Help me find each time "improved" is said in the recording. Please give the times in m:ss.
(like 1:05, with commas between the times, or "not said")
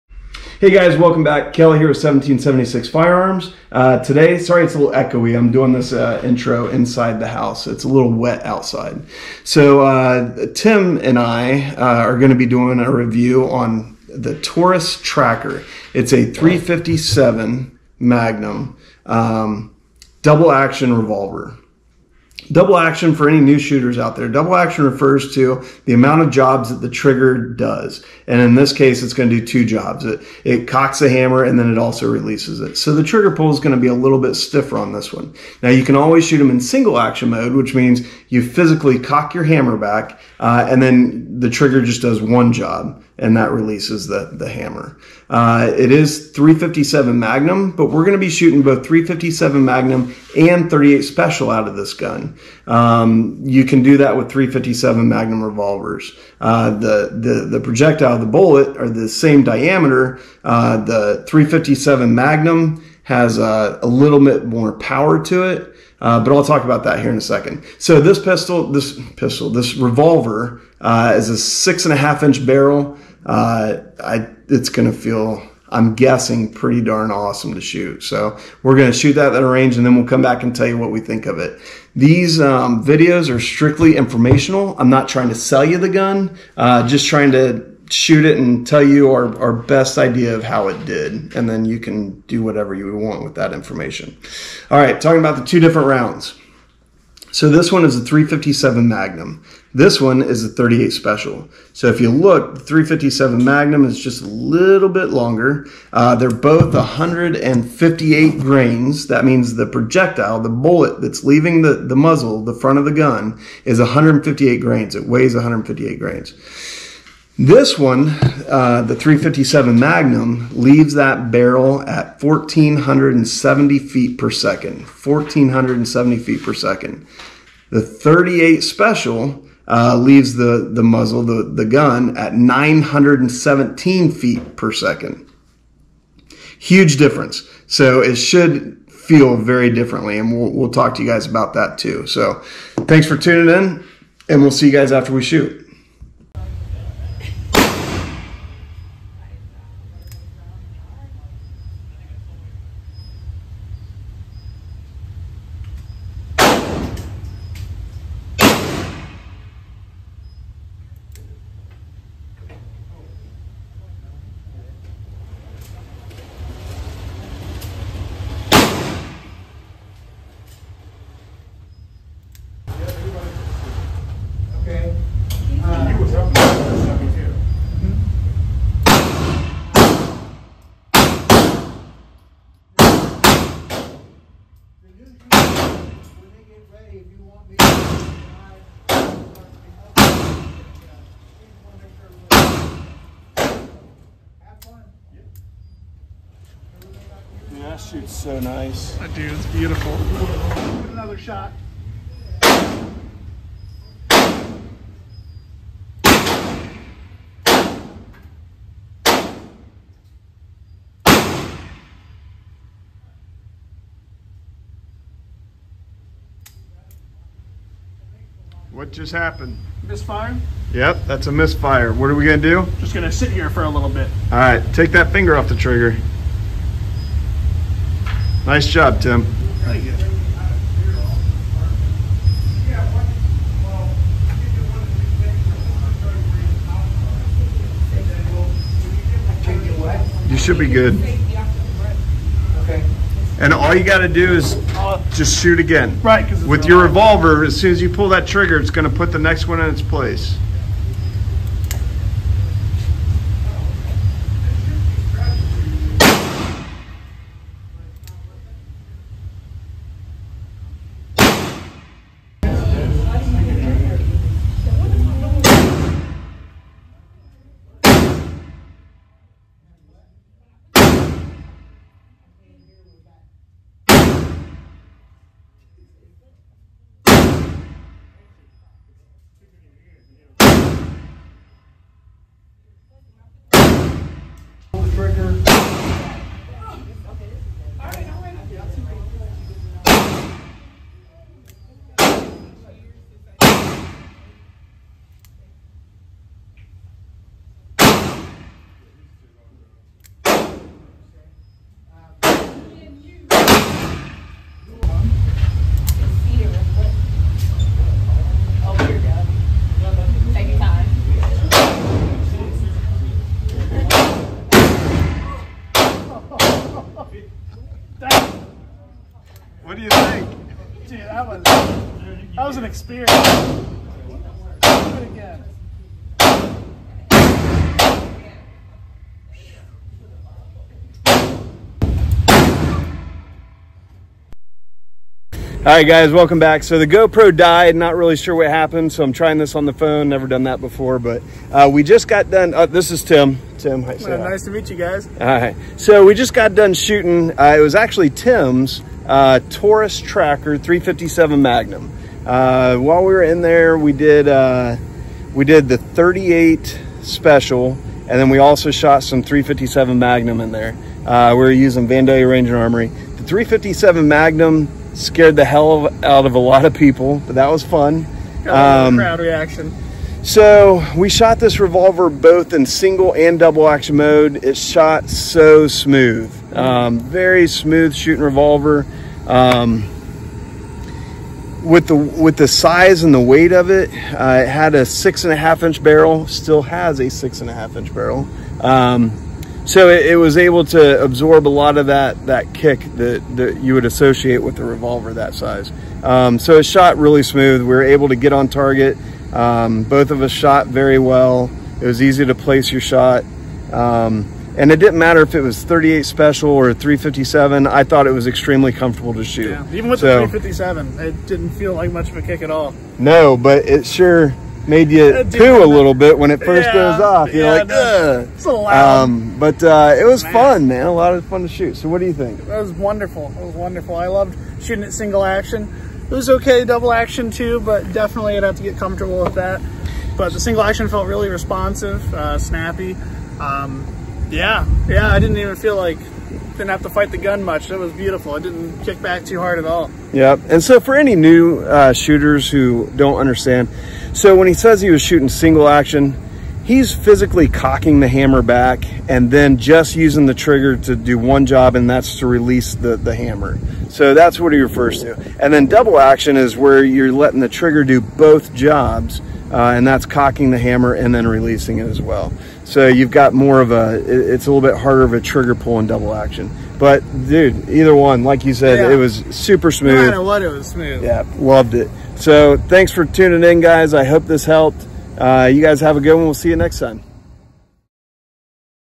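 not said.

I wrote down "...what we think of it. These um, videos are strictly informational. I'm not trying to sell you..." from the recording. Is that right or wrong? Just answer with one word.
right.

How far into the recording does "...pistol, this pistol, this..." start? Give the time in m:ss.
1:08.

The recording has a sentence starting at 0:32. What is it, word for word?
So the trigger pull is going to be a little bit stiffer on this one.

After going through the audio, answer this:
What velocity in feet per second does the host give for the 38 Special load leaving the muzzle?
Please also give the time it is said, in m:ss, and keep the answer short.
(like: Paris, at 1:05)
917, at 2:12.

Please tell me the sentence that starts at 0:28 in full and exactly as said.
And in this case, it's going to do two jobs.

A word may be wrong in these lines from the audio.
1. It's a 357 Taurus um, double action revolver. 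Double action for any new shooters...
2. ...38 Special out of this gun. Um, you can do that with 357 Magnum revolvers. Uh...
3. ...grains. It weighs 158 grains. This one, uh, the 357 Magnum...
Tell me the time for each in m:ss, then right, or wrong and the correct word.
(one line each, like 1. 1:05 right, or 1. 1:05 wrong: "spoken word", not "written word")
1. 0:15 wrong: "Magnum", not "Taurus"
2. 0:50 right
3. 1:54 right.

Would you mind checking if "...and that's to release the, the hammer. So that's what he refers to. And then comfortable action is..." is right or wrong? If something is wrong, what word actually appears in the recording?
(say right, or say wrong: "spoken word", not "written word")
wrong: "double", not "comfortable".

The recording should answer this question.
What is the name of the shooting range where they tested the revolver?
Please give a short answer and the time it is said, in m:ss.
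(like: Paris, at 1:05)
Vandalia Ranger Armory, at 6:01.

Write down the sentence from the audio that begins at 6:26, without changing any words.
Still has a six and a half inch barrel.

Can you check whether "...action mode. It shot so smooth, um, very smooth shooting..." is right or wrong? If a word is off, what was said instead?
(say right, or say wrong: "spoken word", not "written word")
right.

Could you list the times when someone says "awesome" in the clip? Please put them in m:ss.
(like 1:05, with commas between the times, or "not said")
1:17.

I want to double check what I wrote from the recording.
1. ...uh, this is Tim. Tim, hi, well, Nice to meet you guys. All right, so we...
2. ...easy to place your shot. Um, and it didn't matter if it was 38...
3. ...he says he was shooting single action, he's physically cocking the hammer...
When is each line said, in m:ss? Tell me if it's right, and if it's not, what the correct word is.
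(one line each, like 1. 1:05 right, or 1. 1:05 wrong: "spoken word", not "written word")
1. 5:42 right
2. 6:42 right
3. 7:24 right.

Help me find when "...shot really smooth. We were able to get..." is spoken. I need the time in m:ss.
6:36.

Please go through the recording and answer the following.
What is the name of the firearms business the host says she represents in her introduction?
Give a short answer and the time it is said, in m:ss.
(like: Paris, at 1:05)
1776 Firearms, at 0:01.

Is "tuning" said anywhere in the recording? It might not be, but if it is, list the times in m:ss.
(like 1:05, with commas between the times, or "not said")
2:23, 7:53.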